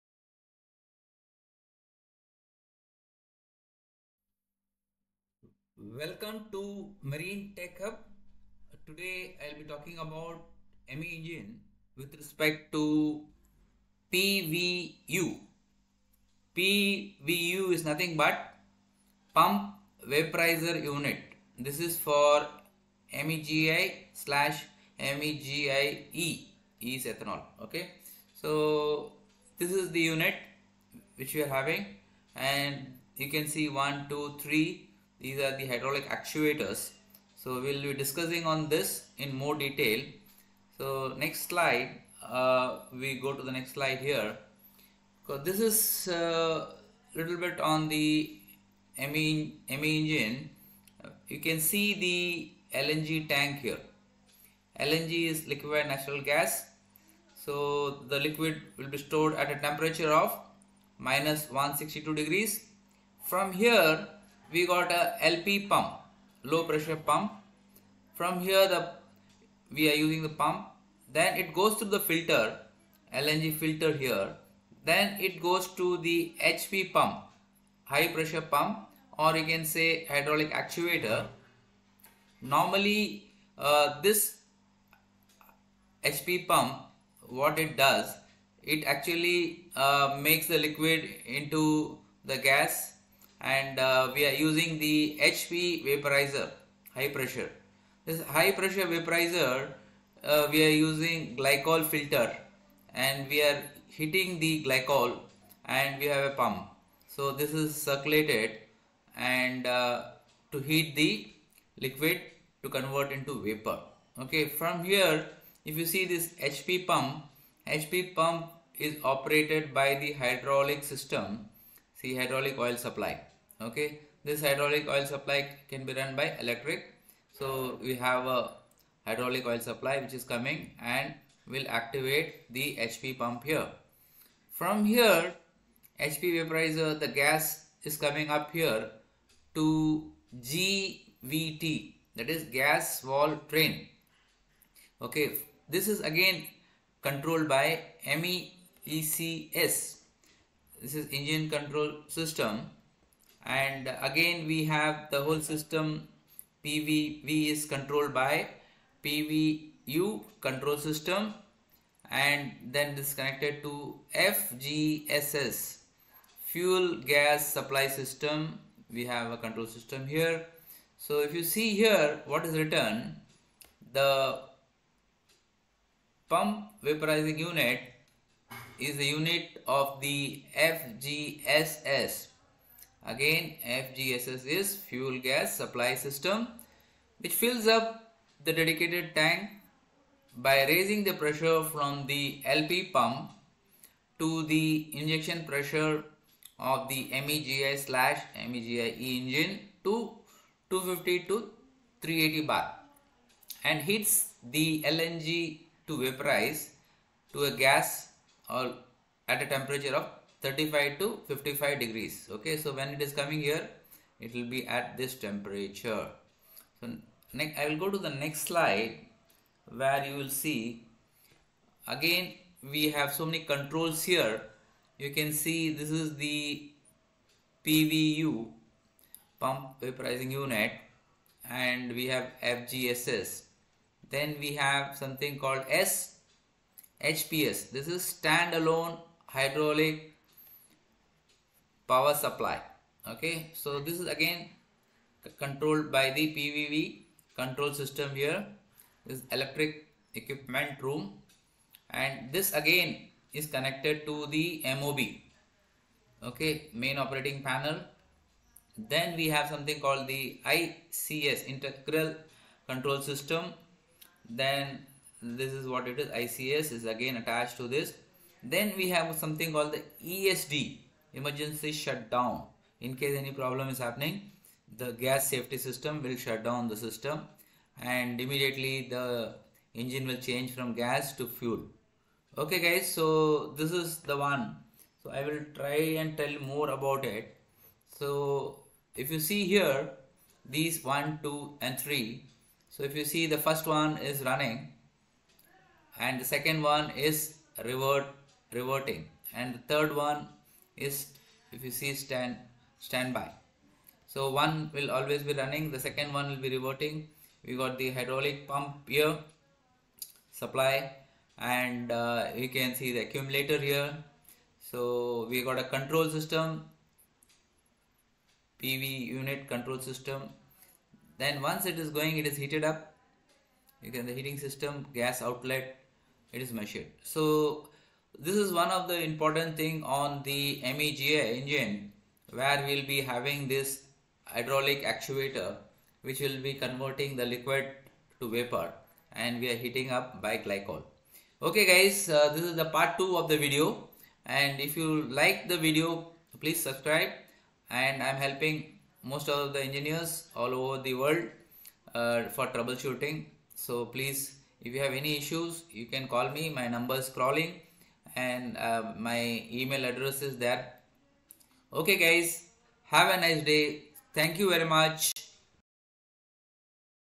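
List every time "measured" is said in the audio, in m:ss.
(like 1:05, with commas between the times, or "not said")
5:26.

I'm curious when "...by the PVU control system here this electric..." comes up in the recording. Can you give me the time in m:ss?
4:05.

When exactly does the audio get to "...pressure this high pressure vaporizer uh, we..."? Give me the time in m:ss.
1:37.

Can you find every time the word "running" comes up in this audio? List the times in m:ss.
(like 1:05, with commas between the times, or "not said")
4:54, 5:05.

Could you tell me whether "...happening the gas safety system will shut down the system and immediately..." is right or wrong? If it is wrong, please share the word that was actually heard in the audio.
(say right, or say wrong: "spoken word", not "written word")
right.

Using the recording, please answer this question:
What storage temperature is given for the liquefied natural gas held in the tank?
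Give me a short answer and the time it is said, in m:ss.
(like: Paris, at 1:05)
-162 degrees, at 1:00.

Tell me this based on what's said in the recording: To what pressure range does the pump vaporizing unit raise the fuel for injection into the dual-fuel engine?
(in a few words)
250 to 380 bar.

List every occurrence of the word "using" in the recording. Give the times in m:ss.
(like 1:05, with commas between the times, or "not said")
1:09, 1:34, 1:40.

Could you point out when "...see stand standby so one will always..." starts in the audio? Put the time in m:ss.
5:01.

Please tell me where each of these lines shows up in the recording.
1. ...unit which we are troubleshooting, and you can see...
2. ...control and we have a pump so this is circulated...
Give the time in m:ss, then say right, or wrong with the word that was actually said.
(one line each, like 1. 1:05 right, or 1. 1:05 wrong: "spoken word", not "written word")
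1. 0:30 wrong: "having", not "troubleshooting"
2. 1:44 wrong: "glycol", not "control".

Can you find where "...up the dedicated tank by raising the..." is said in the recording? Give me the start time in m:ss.
3:07.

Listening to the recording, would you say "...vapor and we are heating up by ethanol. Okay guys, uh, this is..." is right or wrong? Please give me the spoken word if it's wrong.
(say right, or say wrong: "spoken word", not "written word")
wrong: "glycol", not "ethanol".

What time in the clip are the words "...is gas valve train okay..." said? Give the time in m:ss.
2:22.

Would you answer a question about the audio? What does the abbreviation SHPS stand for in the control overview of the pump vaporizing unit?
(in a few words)
standalone hydraulic power supply.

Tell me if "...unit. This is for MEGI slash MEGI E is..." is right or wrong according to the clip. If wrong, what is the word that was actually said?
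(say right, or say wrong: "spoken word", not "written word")
right.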